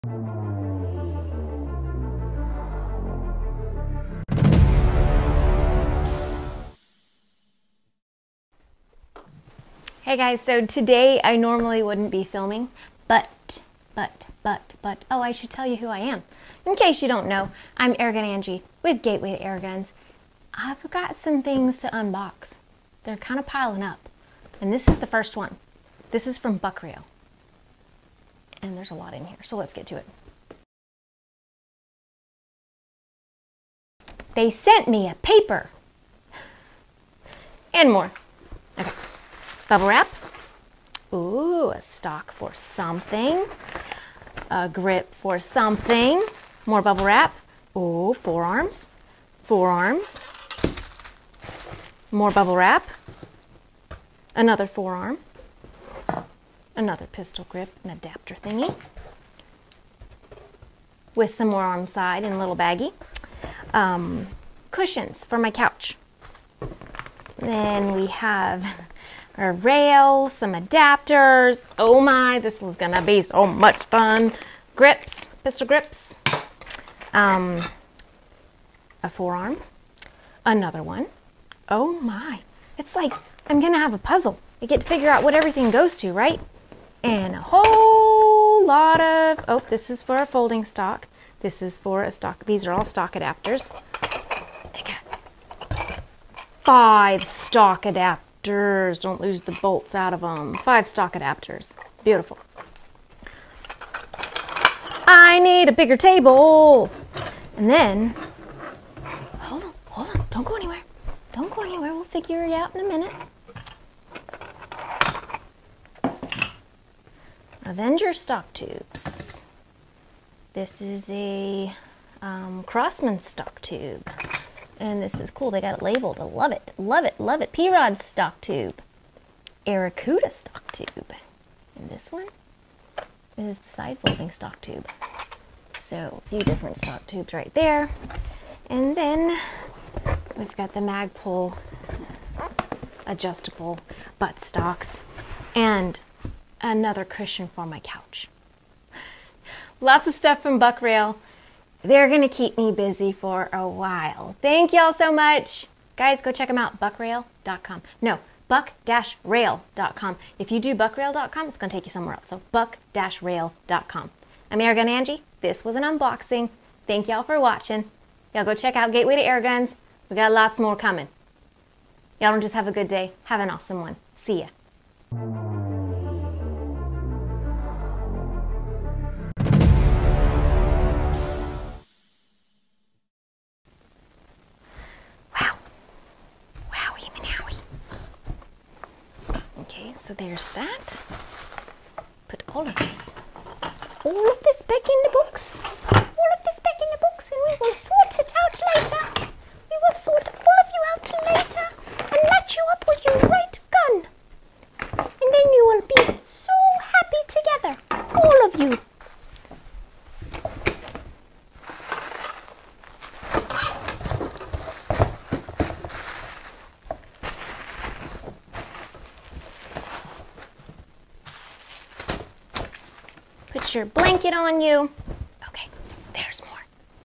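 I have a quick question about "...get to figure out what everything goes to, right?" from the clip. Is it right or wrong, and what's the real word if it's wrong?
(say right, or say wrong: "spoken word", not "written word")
right.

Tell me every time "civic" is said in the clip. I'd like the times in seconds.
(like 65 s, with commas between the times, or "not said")
not said.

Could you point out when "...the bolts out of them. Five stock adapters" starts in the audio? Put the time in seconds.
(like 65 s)
99 s.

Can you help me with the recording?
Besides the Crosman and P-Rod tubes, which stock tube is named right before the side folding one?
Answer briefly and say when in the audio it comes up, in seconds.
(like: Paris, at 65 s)
Aracuda, at 129 s.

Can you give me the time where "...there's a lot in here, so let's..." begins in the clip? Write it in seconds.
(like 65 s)
28 s.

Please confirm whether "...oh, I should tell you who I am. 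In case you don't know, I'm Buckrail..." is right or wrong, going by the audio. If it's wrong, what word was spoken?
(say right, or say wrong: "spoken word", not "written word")
wrong: "Airgun", not "Buckrail".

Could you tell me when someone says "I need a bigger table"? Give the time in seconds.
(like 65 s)
105 s.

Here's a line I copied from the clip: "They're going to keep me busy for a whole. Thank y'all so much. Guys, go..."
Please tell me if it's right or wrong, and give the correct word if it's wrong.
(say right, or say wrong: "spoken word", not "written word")
wrong: "while", not "whole".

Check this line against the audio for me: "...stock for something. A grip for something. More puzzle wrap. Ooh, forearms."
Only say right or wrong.
wrong.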